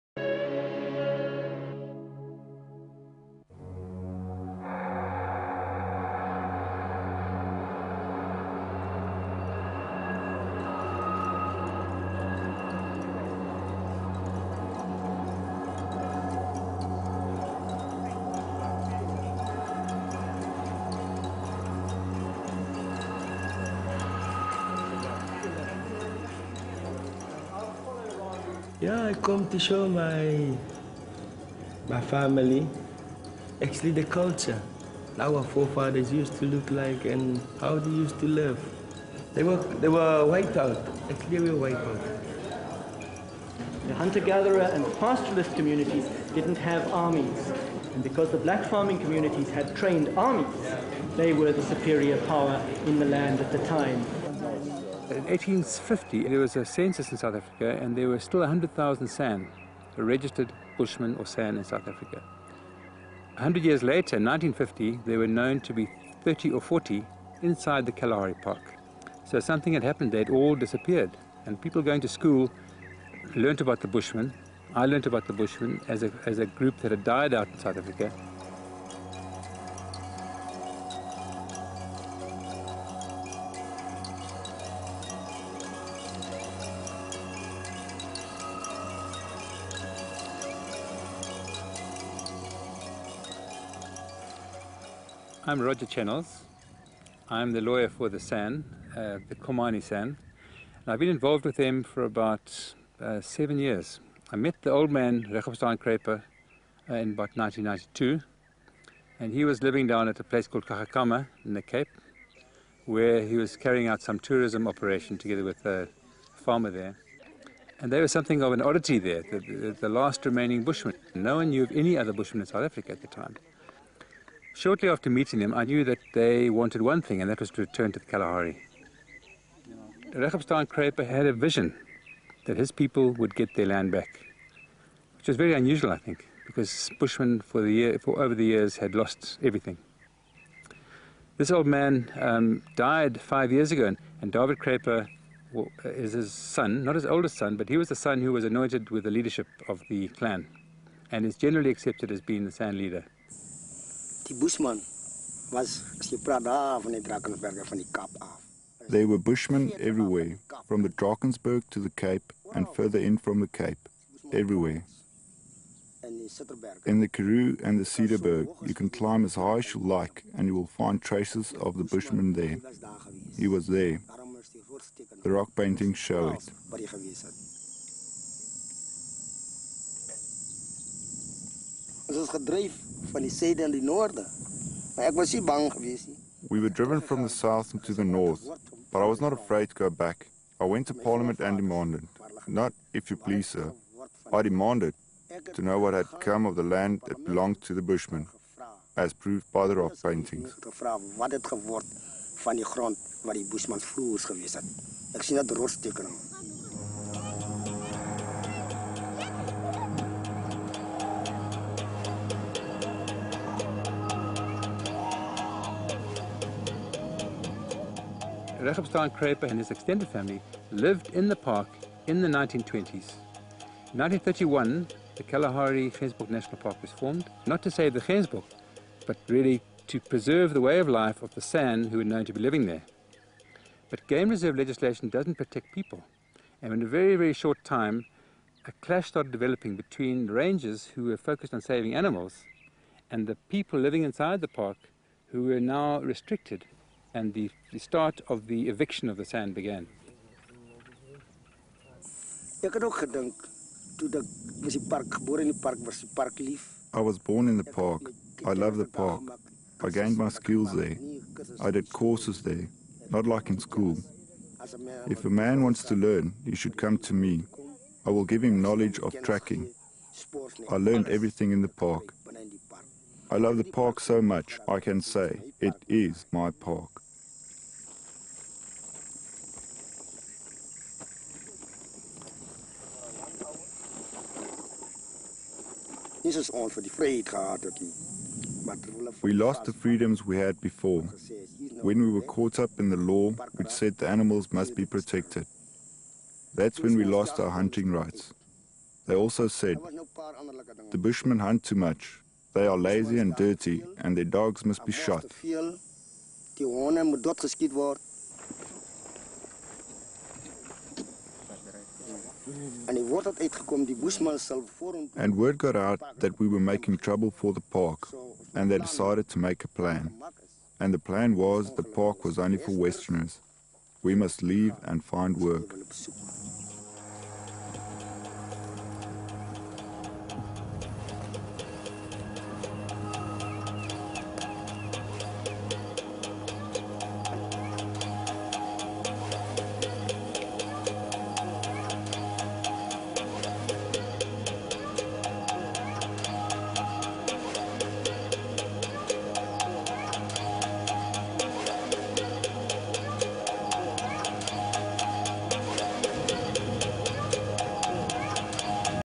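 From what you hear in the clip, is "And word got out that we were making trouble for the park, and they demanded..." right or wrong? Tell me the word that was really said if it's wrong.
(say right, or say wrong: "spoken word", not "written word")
wrong: "decided", not "demanded".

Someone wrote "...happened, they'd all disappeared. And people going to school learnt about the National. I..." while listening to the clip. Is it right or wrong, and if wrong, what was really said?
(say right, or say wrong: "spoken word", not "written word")
wrong: "Bushmen", not "National".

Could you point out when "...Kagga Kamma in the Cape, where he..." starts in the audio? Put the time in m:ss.
1:50.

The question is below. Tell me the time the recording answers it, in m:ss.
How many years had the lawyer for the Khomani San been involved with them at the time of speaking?
1:43.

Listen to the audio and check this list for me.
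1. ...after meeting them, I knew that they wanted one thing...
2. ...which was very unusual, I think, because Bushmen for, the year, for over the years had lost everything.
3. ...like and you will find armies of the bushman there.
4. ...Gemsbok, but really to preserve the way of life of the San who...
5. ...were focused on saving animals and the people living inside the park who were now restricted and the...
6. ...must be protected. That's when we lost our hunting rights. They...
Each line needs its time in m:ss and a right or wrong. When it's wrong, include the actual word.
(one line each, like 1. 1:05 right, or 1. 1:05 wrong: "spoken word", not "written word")
1. 2:04 right
2. 2:15 right
3. 2:49 wrong: "traces", not "armies"
4. 3:48 right
5. 4:01 right
6. 4:54 right.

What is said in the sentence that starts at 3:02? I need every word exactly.
Ons is gedryf we were driven from the south into the north, but I was not afraid to go back.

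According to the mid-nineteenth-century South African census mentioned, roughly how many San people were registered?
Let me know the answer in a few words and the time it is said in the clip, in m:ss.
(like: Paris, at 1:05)
100,000, at 0:58.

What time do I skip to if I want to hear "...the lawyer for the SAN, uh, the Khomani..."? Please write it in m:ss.
1:37.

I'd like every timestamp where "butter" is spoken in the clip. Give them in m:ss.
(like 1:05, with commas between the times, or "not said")
not said.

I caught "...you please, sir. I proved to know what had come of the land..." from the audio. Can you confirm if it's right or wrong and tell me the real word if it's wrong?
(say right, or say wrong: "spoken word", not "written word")
wrong: "demanded", not "proved".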